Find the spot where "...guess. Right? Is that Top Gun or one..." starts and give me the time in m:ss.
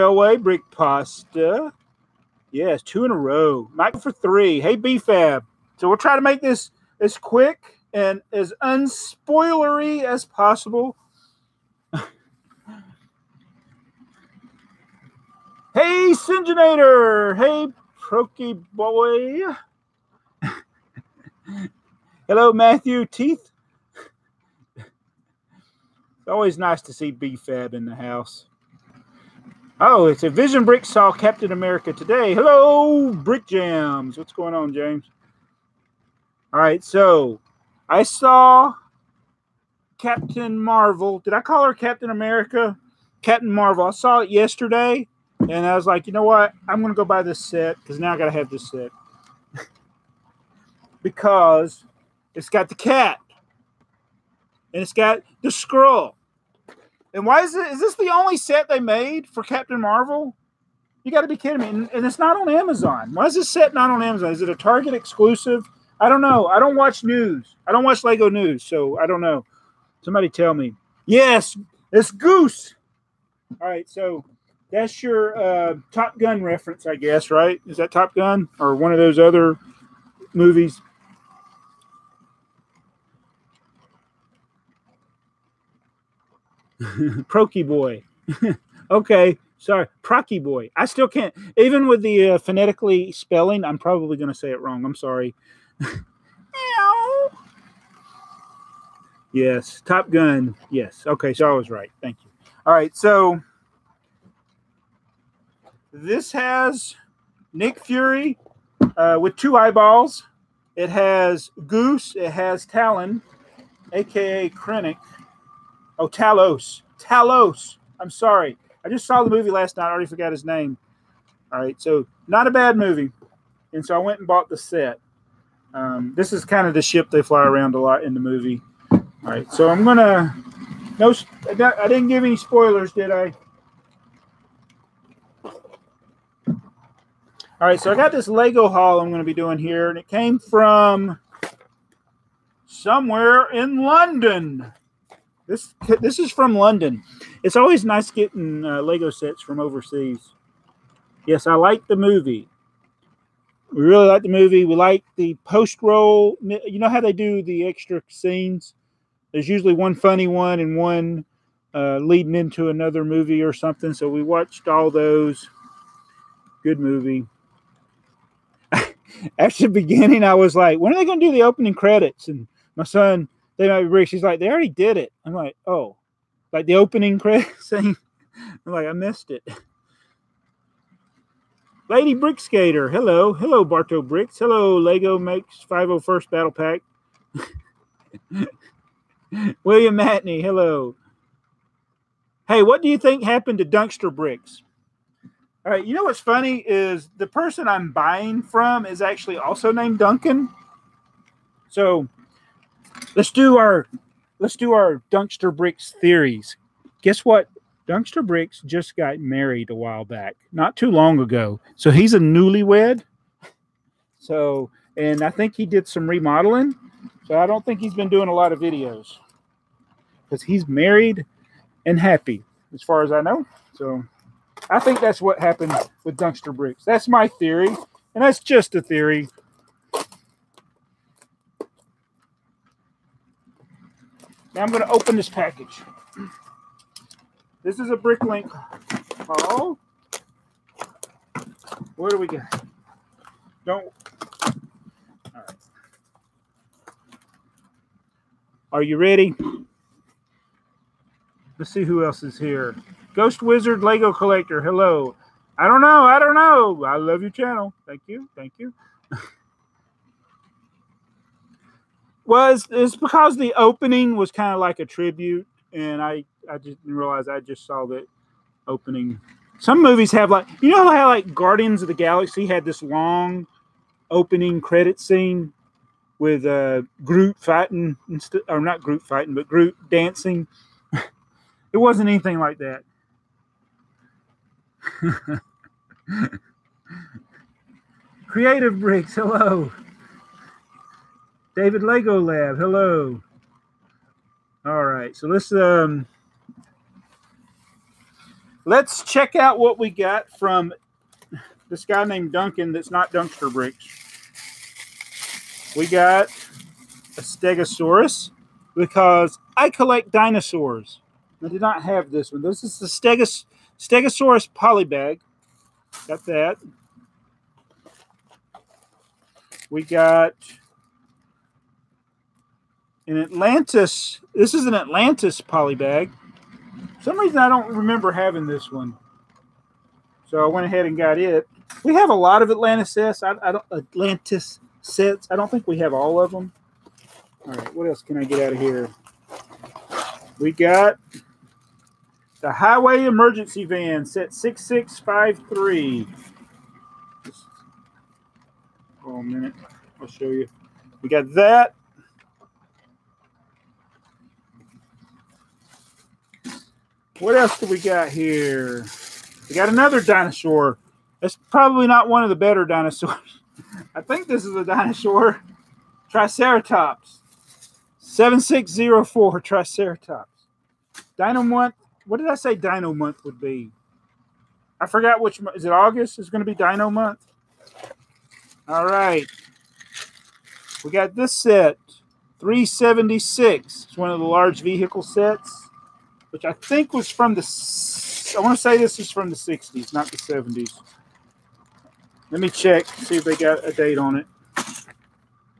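1:16.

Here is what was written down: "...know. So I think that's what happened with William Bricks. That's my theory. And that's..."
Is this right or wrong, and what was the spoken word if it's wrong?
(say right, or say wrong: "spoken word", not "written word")
wrong: "Dunkster", not "William".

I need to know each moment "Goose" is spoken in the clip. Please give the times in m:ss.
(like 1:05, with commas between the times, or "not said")
1:12, 1:51.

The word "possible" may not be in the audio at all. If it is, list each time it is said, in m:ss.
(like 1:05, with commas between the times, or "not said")
0:10.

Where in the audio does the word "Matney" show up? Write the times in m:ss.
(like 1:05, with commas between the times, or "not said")
3:09.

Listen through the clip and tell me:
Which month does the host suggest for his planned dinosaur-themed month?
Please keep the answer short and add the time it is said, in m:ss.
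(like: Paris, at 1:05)
August, at 6:15.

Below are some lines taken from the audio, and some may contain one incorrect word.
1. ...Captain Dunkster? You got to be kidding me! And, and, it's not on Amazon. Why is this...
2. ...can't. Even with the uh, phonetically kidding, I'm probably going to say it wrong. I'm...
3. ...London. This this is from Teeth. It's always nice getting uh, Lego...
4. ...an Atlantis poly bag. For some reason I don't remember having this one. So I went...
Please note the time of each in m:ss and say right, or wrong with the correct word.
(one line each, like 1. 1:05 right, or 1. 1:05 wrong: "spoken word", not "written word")
1. 0:59 wrong: "Marvel", not "Dunkster"
2. 1:31 wrong: "spelling", not "kidding"
3. 2:23 wrong: "London", not "Teeth"
4. 5:24 right.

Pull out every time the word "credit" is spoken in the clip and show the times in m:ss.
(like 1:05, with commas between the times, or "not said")
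2:51, 2:57, 4:34.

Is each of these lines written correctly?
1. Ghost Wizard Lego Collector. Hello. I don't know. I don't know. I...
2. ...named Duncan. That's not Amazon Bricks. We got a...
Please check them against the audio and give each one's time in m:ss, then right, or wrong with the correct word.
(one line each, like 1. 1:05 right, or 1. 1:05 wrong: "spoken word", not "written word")
1. 4:13 right
2. 5:02 wrong: "Dunkster", not "Amazon".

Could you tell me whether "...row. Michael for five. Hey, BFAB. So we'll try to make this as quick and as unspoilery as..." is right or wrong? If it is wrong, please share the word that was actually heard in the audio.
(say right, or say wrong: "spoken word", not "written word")
wrong: "three", not "five".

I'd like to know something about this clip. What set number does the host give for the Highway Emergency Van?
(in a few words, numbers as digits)
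6653.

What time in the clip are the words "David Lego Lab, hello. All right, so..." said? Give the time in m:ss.
4:51.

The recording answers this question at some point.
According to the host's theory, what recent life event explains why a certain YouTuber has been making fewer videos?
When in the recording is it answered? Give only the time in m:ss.
3:28.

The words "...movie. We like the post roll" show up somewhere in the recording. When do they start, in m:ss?
2:34.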